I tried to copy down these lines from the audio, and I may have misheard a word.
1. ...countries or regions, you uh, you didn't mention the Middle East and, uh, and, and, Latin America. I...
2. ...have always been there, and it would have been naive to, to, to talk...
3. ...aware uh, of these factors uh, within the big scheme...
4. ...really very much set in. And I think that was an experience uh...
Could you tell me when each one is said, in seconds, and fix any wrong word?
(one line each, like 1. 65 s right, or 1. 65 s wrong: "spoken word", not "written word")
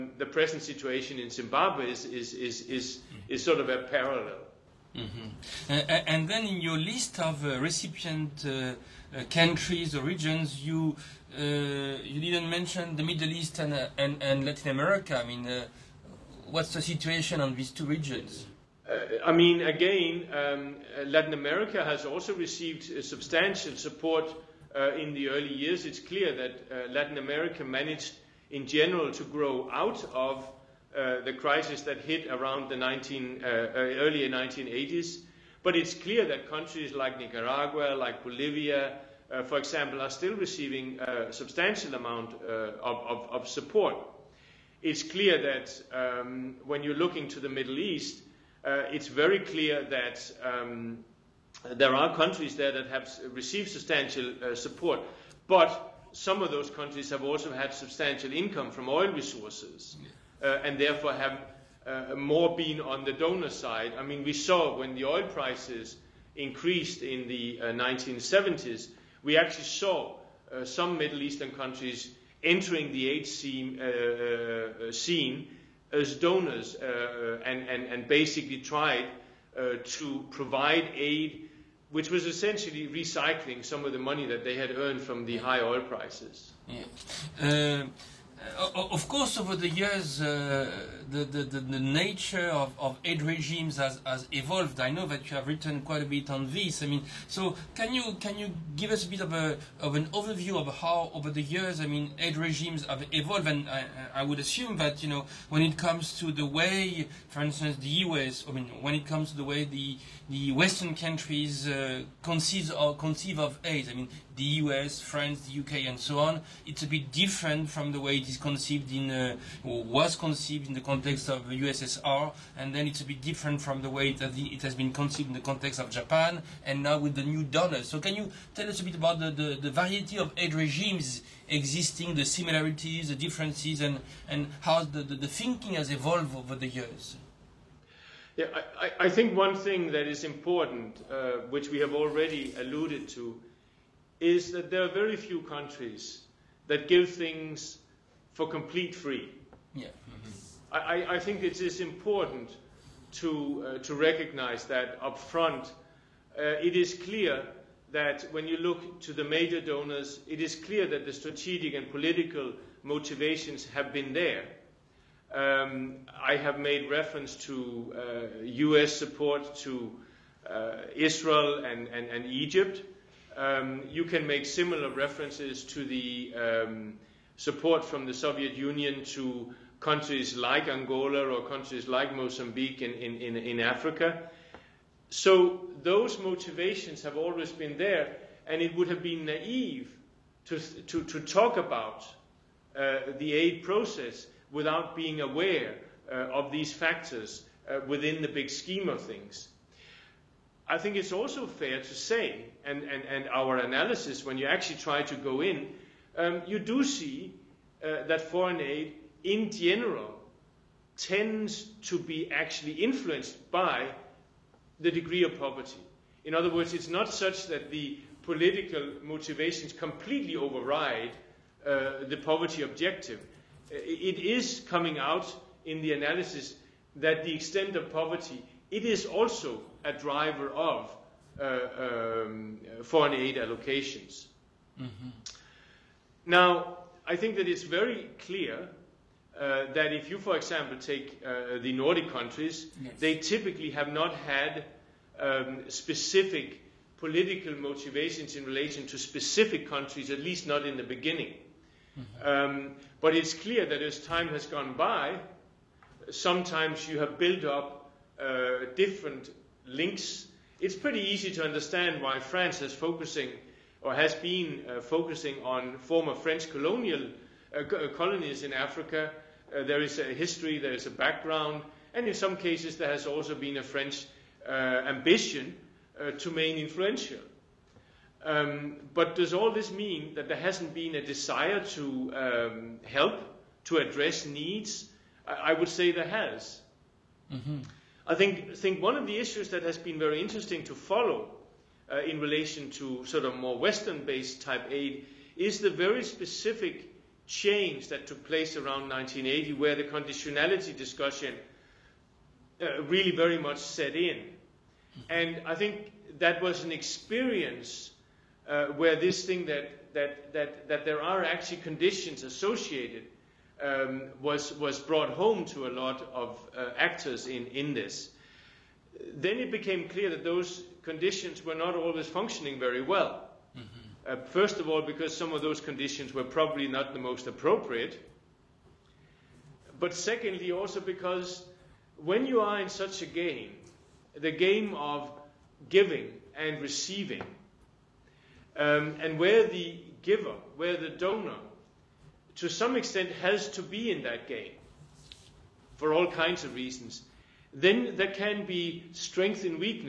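1. 9 s right
2. 187 s right
3. 195 s right
4. 302 s right.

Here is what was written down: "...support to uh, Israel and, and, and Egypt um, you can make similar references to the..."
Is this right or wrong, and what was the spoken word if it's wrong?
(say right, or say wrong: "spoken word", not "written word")
right.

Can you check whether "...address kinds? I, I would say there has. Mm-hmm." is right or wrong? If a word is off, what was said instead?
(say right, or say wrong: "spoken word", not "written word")
wrong: "needs", not "kinds".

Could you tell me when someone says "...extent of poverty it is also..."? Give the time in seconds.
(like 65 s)
227 s.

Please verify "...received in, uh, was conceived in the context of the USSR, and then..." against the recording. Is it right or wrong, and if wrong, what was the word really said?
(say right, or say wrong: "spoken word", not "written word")
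wrong: "conceived", not "received".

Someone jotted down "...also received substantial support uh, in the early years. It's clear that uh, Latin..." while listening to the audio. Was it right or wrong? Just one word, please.
right.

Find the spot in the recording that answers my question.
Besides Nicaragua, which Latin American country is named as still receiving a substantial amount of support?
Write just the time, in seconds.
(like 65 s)
38 s.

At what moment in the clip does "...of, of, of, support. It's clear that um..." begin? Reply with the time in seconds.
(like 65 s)
42 s.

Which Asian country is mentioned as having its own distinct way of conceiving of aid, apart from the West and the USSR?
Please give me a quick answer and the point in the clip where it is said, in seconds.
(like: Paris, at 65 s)
Japan, at 125 s.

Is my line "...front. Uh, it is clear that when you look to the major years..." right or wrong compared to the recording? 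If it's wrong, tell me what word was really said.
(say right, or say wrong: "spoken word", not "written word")
wrong: "donors", not "years".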